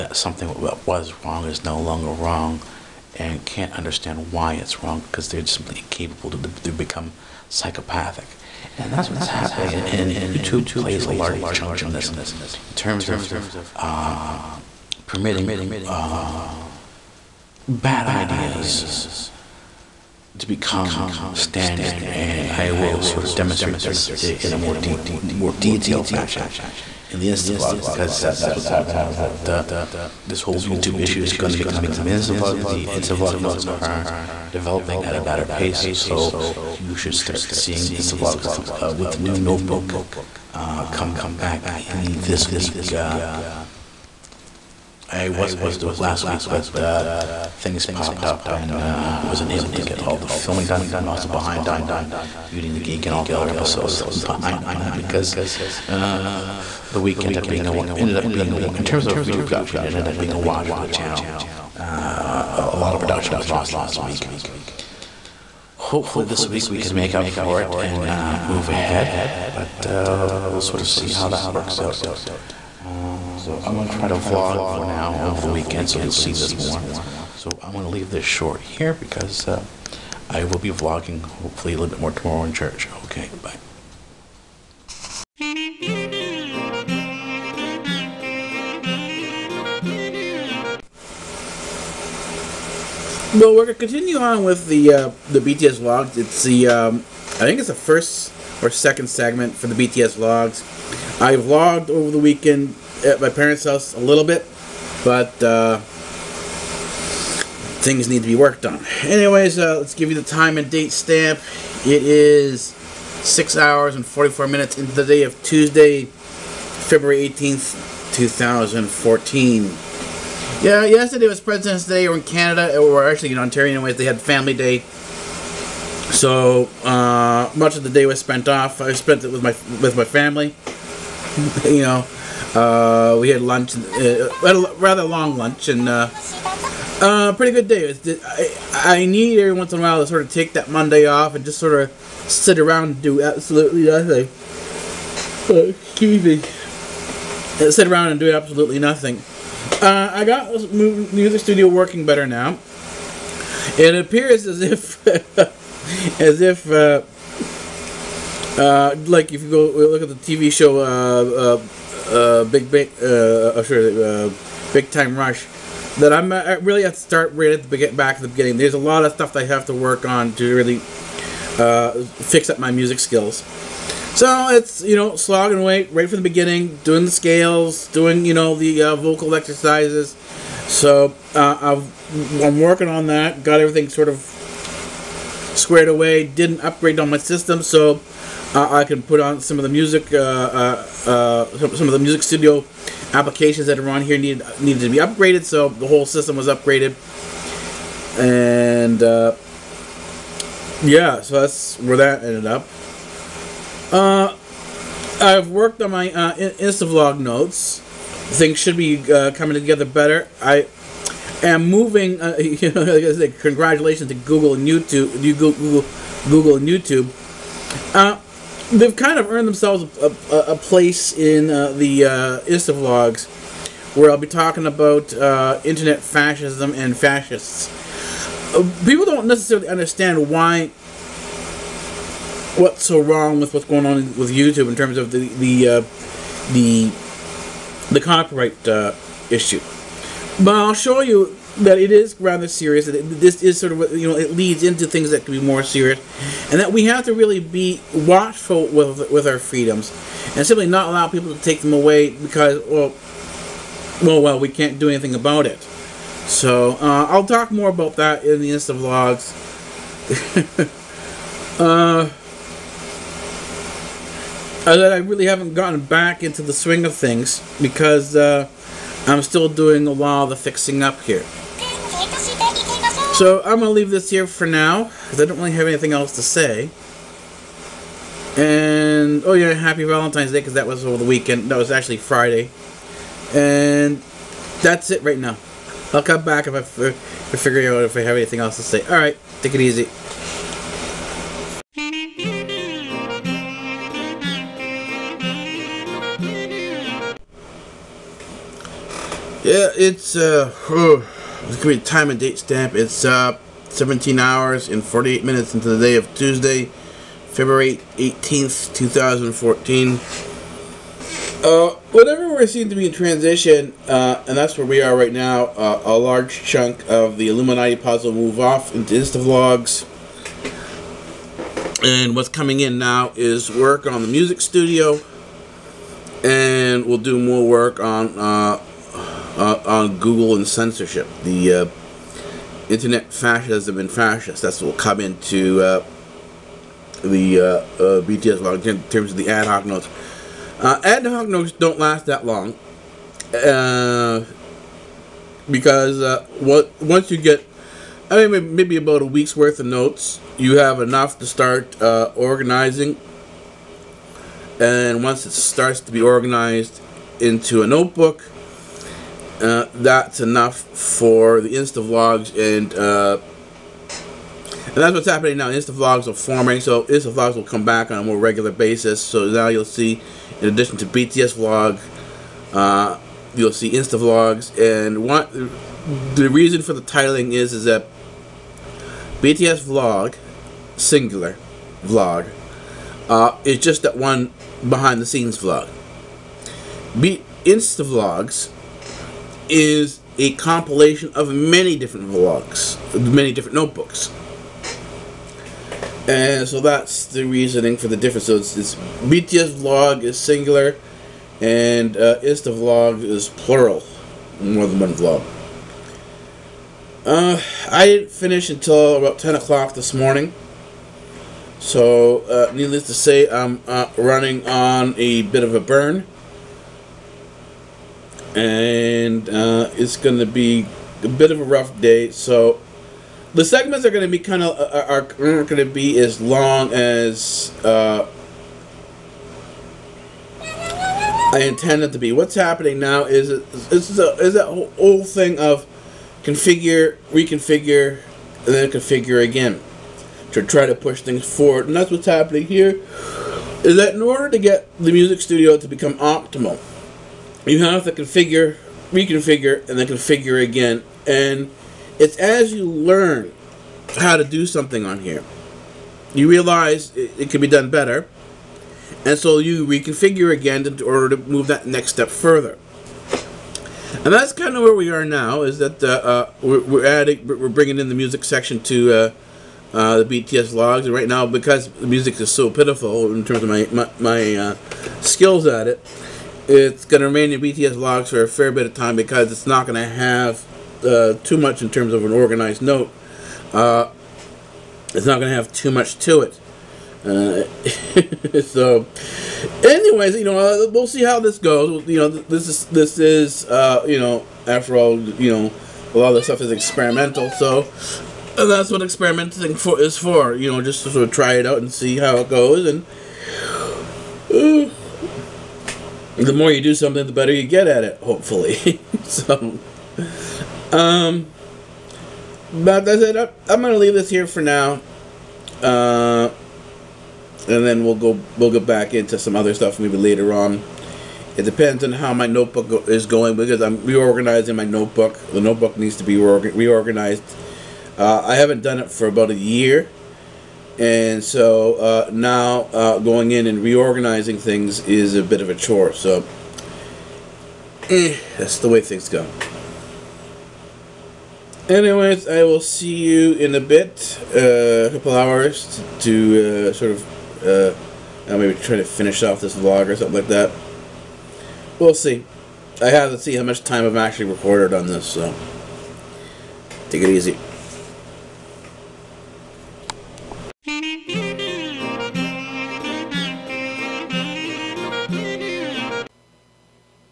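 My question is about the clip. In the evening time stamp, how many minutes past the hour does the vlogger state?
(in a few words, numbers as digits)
48.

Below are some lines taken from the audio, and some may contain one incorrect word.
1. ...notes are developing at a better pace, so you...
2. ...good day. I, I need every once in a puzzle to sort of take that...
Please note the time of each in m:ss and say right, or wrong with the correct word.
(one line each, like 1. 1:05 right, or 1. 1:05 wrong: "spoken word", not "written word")
1. 0:33 right
2. 2:17 wrong: "while", not "puzzle".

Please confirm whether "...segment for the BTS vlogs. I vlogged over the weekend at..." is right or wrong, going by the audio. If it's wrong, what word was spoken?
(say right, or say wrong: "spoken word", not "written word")
right.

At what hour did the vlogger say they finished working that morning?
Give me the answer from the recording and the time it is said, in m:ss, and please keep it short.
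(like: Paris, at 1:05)
10 o'clock, at 6:49.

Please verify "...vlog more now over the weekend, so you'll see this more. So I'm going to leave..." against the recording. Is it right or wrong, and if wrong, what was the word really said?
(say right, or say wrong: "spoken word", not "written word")
right.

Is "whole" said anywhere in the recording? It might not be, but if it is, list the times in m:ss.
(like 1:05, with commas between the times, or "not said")
0:30, 3:15, 7:14.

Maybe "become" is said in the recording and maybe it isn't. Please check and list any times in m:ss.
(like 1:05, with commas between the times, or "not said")
0:06, 0:20, 7:25.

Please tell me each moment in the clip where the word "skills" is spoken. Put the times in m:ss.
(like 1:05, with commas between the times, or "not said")
2:52, 7:54.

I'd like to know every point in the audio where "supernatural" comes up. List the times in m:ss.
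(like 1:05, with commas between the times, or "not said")
not said.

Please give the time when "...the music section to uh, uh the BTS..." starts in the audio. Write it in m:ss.
7:47.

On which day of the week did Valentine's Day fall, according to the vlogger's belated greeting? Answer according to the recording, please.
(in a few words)
Friday.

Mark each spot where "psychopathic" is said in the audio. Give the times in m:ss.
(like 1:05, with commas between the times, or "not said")
0:07.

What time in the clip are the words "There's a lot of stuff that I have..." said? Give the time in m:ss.
2:48.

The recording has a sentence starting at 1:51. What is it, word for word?
It is 6 hours and 44 minutes into the day of Tuesday, February 18th, 2014.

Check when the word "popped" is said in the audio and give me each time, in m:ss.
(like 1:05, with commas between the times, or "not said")
0:47.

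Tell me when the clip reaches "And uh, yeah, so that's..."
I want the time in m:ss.
3:18.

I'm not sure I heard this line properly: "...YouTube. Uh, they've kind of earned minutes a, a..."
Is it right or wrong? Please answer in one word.
wrong.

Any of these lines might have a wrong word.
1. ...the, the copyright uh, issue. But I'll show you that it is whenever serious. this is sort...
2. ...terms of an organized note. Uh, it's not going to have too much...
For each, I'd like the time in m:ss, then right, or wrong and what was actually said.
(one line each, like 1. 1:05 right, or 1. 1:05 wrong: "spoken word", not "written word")
1. 3:56 wrong: "rather", not "whenever"
2. 8:01 right.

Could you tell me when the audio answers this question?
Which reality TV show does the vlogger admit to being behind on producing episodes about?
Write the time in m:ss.
0:52.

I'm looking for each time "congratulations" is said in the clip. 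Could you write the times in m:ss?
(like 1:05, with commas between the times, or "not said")
3:33.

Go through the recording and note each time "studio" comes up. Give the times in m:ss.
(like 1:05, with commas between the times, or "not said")
2:31, 3:12, 5:24, 7:25.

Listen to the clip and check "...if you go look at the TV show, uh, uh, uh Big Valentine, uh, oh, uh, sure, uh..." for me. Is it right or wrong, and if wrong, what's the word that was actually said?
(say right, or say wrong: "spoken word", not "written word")
wrong: "Big", not "Valentine".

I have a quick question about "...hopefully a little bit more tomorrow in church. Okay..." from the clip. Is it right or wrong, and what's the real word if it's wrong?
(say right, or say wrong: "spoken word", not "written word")
right.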